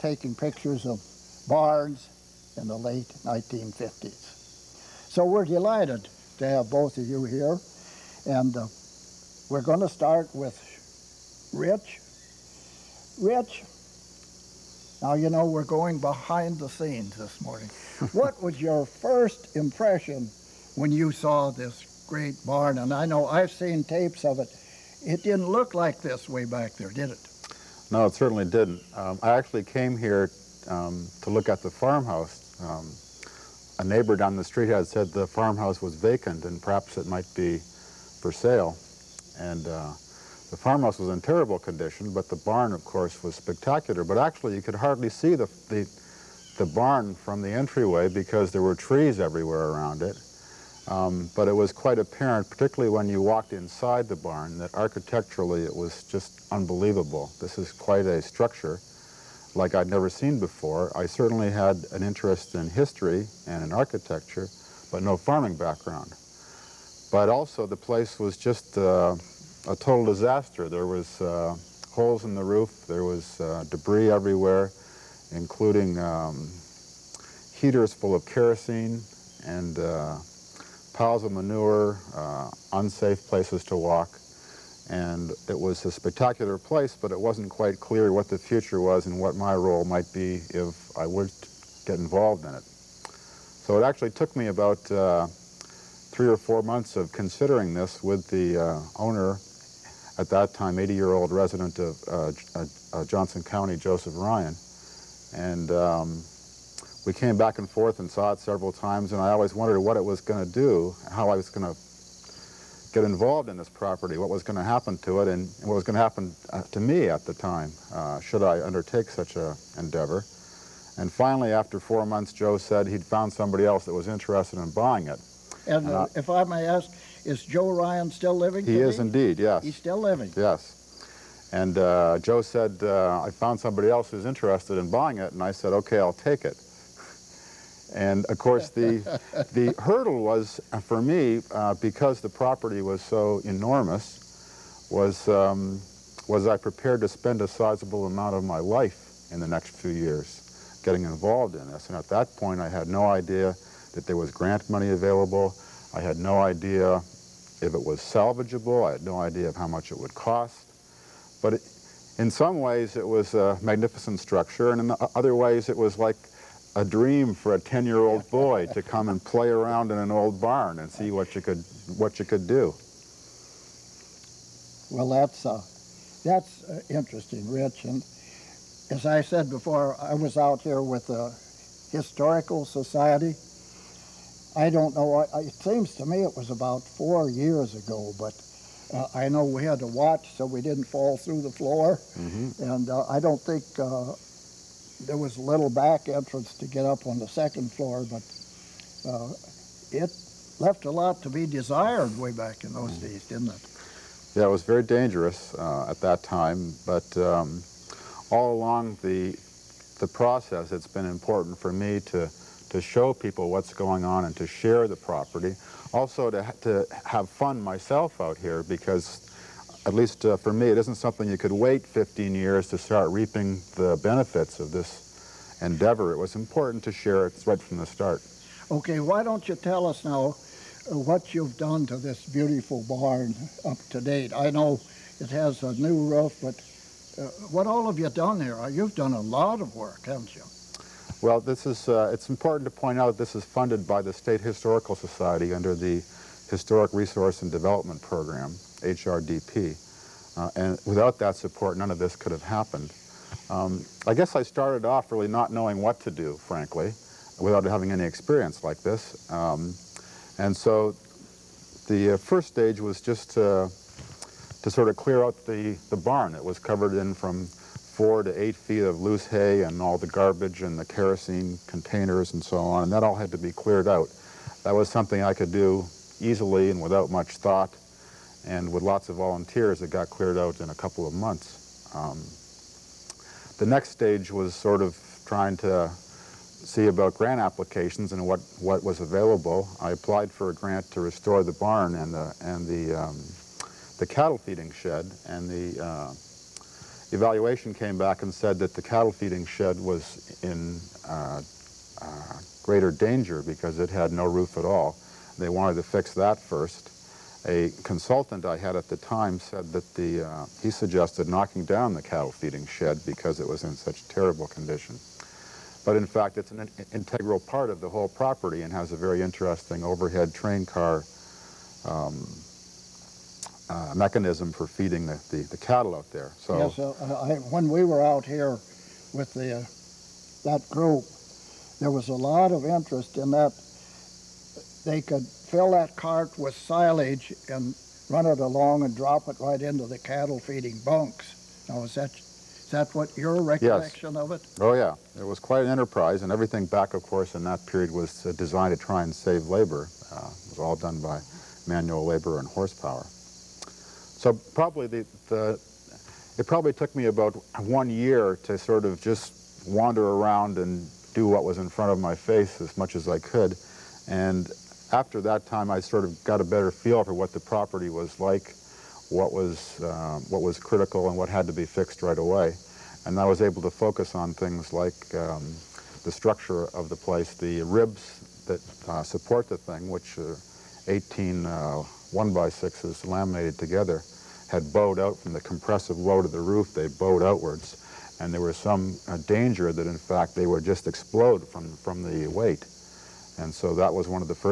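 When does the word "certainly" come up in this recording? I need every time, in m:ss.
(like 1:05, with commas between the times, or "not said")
0:28, 1:01.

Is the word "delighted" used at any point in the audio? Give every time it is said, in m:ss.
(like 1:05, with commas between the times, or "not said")
0:05.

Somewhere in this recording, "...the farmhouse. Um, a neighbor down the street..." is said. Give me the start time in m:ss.
0:31.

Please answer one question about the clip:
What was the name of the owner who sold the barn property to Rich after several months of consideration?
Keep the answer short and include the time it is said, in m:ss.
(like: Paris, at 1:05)
Joseph Ryan, at 1:43.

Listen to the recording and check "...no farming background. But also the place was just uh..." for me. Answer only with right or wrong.
right.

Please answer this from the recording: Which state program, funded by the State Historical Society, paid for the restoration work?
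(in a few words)
Historic Resource and Development Program.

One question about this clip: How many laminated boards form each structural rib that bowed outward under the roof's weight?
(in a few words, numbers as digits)
18.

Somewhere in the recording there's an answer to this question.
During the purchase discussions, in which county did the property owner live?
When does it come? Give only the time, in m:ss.
1:43.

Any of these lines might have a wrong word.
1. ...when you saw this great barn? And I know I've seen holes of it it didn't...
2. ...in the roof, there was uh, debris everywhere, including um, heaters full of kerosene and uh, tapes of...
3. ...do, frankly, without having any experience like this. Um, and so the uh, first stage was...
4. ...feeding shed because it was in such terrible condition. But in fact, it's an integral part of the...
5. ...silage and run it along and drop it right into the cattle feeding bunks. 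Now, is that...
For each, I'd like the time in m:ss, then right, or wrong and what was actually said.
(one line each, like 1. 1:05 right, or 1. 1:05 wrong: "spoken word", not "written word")
1. 0:20 wrong: "tapes", not "holes"
2. 1:12 wrong: "piles", not "tapes"
3. 4:16 right
4. 5:12 right
5. 5:36 right.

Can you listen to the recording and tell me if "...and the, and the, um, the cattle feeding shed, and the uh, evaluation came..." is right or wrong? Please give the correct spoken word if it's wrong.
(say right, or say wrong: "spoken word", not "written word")
right.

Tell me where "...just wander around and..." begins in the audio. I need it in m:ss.
5:59.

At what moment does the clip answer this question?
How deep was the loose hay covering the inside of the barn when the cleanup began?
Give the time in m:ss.
4:27.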